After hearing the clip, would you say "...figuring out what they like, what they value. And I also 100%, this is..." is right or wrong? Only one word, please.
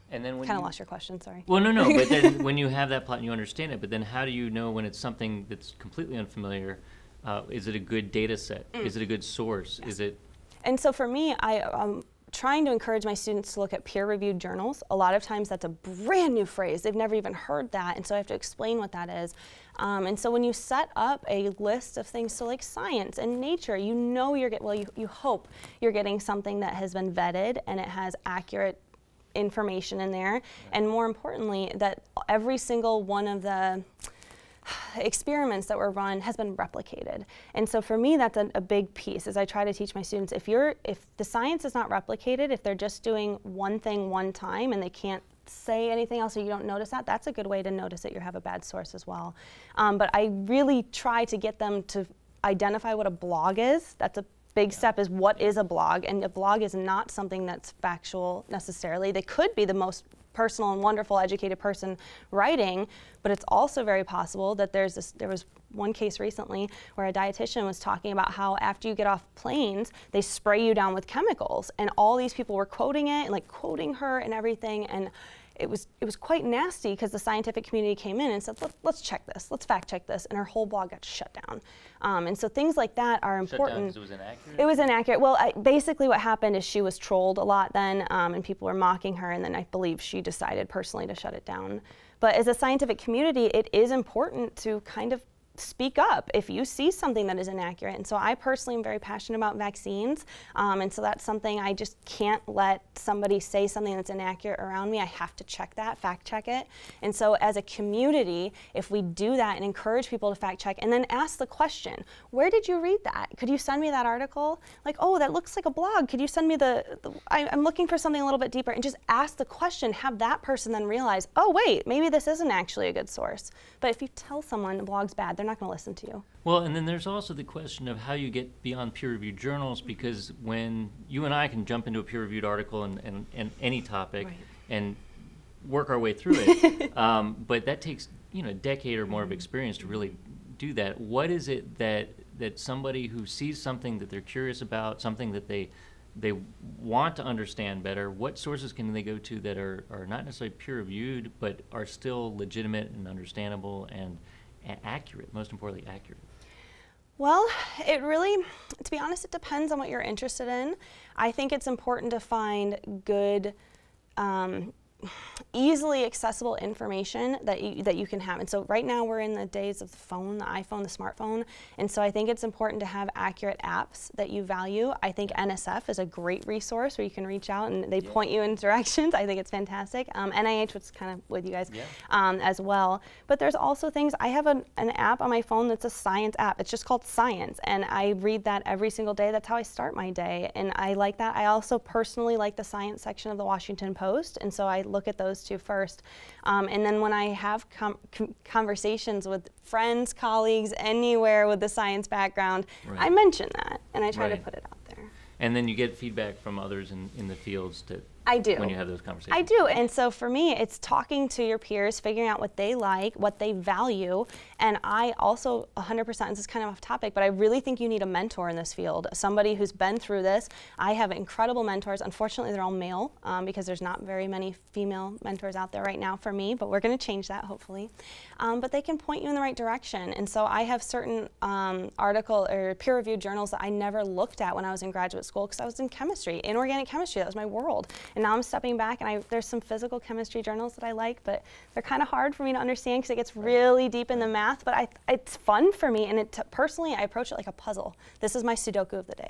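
right.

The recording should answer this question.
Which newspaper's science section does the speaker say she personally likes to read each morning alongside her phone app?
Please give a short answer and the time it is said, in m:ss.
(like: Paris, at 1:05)
Washington Post, at 3:13.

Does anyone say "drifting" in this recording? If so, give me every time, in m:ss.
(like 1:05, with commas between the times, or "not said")
not said.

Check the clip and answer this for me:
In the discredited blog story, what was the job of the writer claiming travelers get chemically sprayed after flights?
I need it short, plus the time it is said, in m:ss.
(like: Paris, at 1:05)
dietitian, at 1:07.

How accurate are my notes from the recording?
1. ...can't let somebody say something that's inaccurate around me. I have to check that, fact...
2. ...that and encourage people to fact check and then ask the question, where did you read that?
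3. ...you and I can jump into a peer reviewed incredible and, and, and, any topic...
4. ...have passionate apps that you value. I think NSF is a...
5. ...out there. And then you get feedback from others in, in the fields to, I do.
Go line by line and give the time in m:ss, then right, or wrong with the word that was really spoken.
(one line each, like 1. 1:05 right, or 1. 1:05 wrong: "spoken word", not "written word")
1. 1:42 right
2. 1:49 right
3. 2:11 wrong: "article", not "incredible"
4. 2:52 wrong: "accurate", not "passionate"
5. 3:24 right.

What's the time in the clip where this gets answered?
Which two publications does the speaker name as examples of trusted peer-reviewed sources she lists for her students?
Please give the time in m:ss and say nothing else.
0:22.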